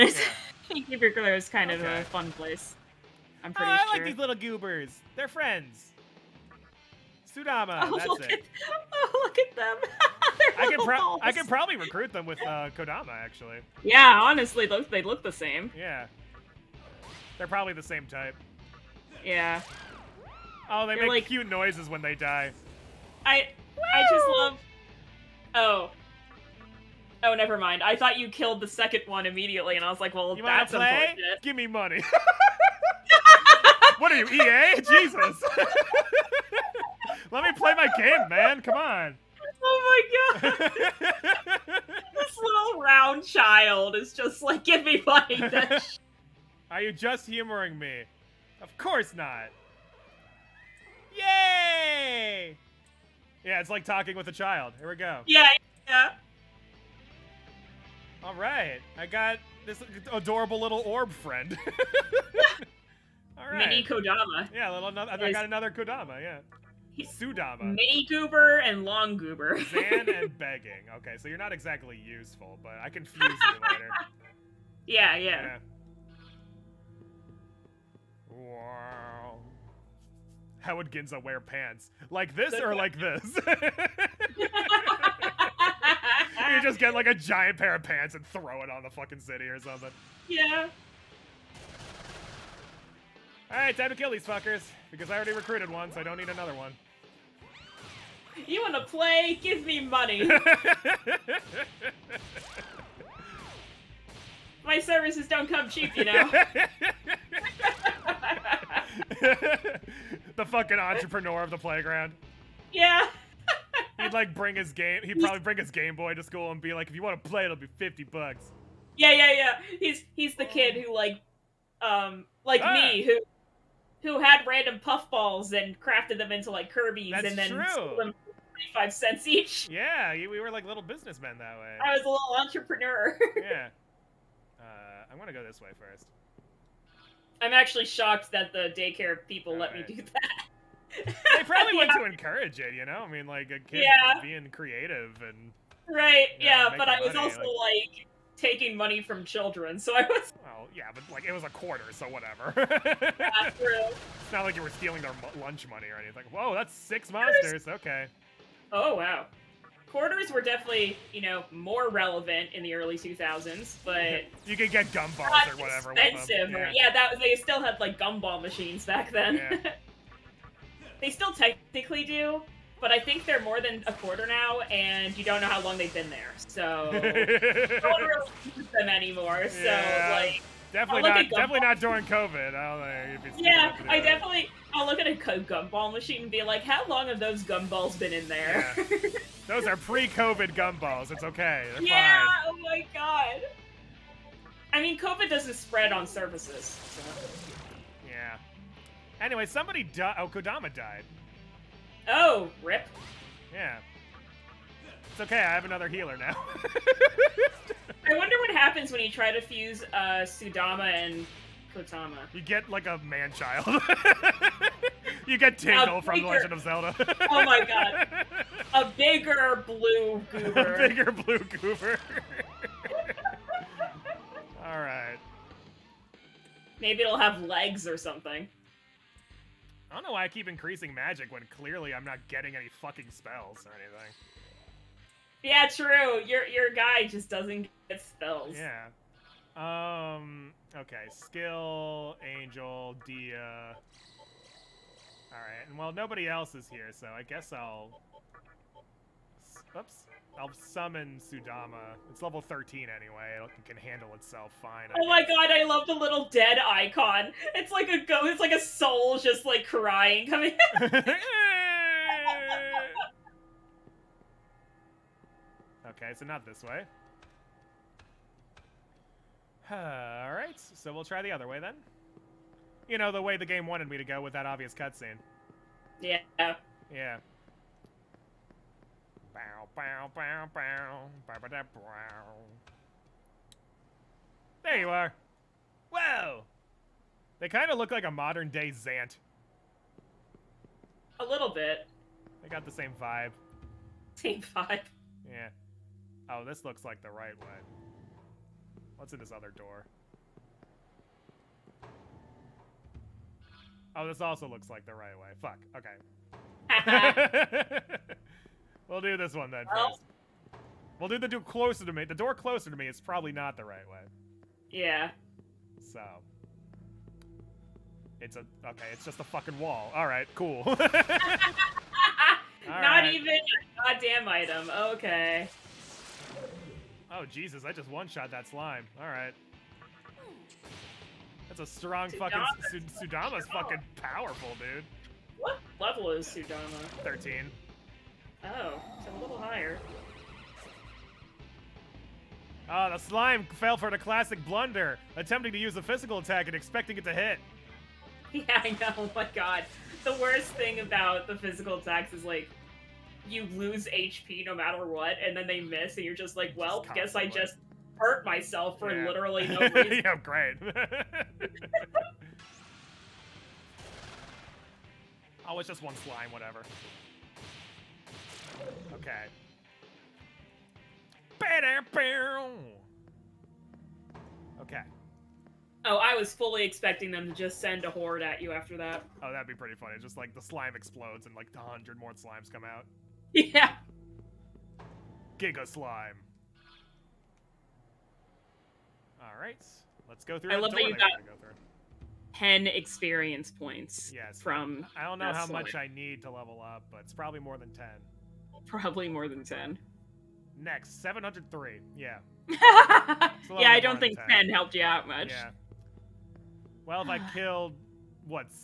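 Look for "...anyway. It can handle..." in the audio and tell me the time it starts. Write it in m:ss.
4:12.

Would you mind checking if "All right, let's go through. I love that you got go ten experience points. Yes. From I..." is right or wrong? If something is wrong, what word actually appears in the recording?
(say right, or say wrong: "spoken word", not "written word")
right.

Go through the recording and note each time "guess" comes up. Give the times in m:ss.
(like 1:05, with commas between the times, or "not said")
4:07, 4:15, 5:56.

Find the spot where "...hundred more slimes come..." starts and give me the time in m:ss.
6:21.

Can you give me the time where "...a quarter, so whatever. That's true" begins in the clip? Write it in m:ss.
2:31.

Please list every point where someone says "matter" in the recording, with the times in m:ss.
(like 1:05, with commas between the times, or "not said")
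5:54.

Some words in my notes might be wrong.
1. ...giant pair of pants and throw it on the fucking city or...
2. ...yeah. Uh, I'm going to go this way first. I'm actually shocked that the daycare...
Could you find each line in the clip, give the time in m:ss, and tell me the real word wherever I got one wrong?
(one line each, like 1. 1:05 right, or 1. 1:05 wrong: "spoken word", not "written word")
1. 1:27 right
2. 2:13 right.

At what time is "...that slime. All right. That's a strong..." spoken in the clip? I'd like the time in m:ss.
5:28.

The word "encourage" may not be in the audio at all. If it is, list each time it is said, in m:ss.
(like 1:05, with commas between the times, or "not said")
2:22.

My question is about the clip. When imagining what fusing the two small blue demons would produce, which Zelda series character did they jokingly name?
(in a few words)
Tingle.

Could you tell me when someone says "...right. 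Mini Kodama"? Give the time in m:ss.
1:03.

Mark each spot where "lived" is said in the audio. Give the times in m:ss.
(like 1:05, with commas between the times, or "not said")
not said.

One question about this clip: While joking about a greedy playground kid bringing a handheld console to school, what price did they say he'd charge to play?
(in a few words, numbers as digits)
50 bucks.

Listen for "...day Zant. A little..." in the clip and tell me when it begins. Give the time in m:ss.
4:48.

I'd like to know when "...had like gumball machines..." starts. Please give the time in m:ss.
2:47.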